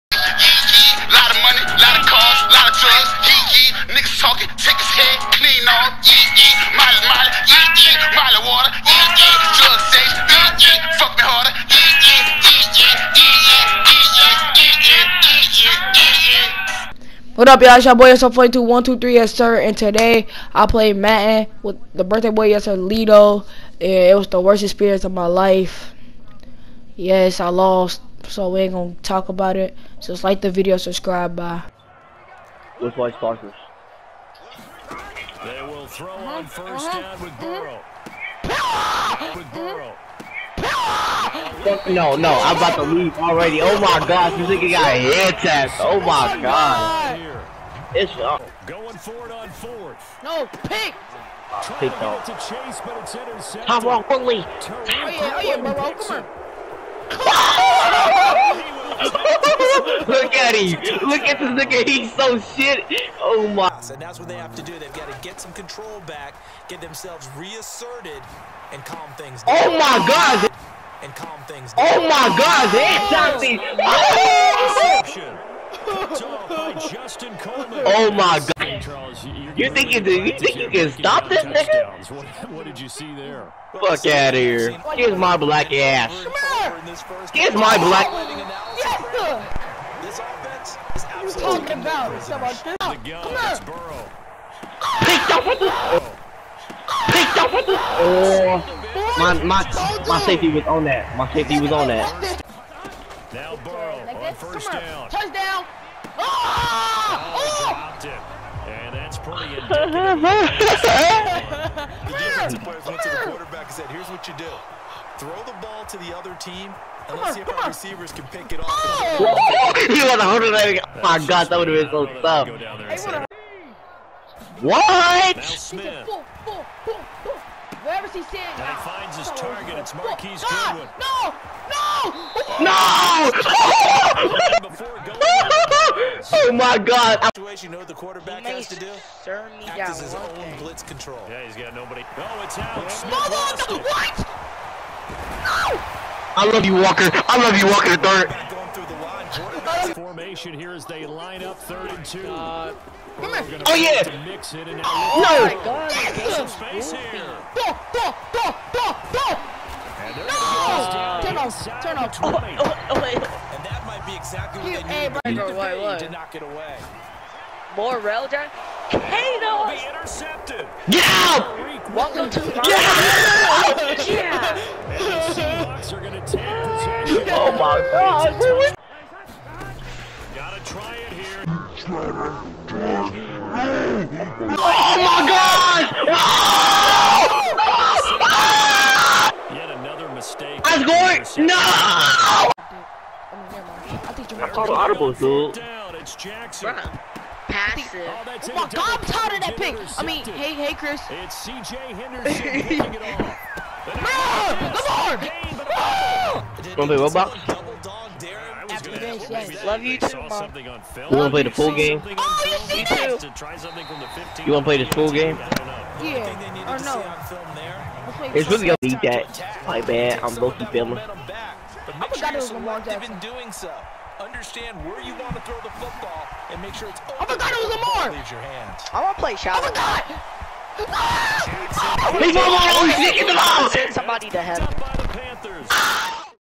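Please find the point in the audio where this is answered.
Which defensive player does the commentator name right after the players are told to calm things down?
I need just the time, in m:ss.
1:17.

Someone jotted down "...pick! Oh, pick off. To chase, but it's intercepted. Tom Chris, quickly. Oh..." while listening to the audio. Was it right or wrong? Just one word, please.
wrong.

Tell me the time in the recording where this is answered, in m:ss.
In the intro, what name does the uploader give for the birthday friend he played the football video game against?
0:22.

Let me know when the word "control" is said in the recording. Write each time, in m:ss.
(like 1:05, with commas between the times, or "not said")
1:05, 2:20.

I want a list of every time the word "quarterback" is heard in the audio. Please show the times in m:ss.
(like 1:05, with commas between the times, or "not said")
1:53, 2:17.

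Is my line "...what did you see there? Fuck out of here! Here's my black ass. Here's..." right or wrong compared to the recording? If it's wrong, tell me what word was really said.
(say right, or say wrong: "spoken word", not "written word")
right.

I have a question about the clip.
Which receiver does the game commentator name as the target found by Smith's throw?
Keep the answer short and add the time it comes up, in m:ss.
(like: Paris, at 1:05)
Marquise Goodwin, at 2:09.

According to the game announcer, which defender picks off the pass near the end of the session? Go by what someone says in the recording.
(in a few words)
CJ Henderson.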